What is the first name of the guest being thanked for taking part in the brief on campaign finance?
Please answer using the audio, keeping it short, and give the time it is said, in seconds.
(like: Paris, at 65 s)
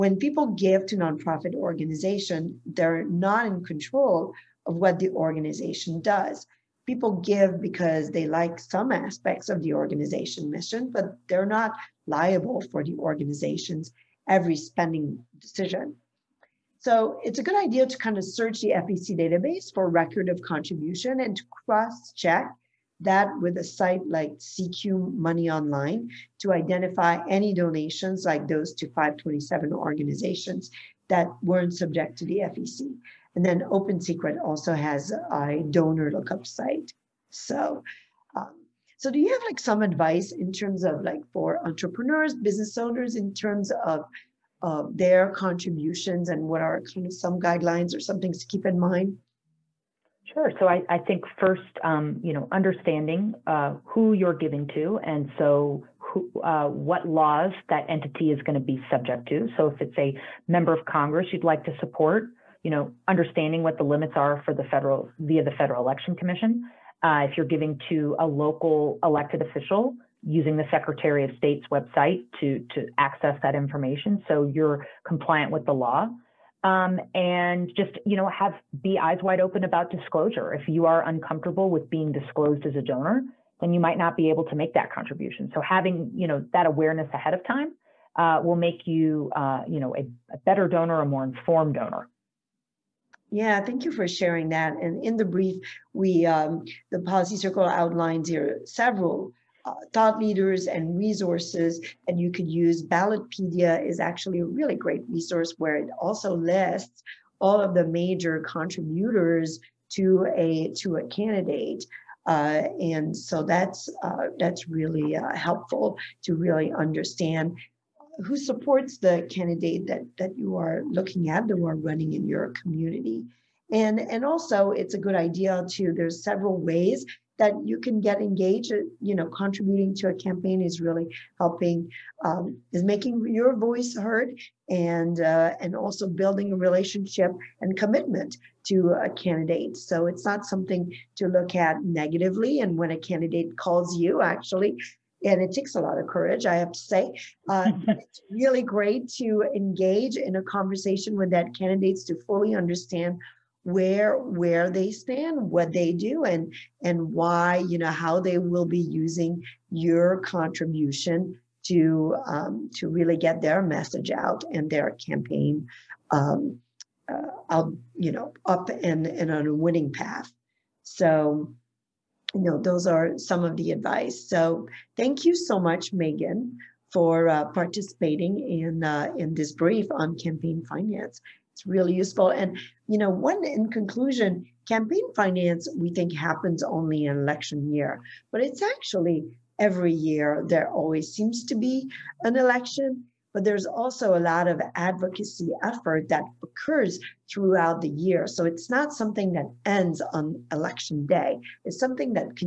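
Megan, at 175 s.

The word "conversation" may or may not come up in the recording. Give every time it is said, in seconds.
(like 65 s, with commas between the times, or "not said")
150 s.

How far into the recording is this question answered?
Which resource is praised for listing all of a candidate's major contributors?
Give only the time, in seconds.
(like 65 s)
102 s.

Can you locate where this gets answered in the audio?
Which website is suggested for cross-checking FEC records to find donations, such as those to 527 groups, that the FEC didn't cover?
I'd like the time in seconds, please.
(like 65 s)
24 s.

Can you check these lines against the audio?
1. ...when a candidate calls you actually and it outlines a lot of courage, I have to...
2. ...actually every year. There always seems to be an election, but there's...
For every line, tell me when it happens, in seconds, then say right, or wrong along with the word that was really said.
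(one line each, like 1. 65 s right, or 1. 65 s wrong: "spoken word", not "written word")
1. 142 s wrong: "takes", not "outlines"
2. 188 s right.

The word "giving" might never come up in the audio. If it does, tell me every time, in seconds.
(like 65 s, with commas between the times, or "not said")
54 s, 67 s.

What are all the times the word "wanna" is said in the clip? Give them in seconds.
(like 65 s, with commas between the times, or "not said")
not said.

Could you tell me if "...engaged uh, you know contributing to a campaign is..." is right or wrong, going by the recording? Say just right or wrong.
right.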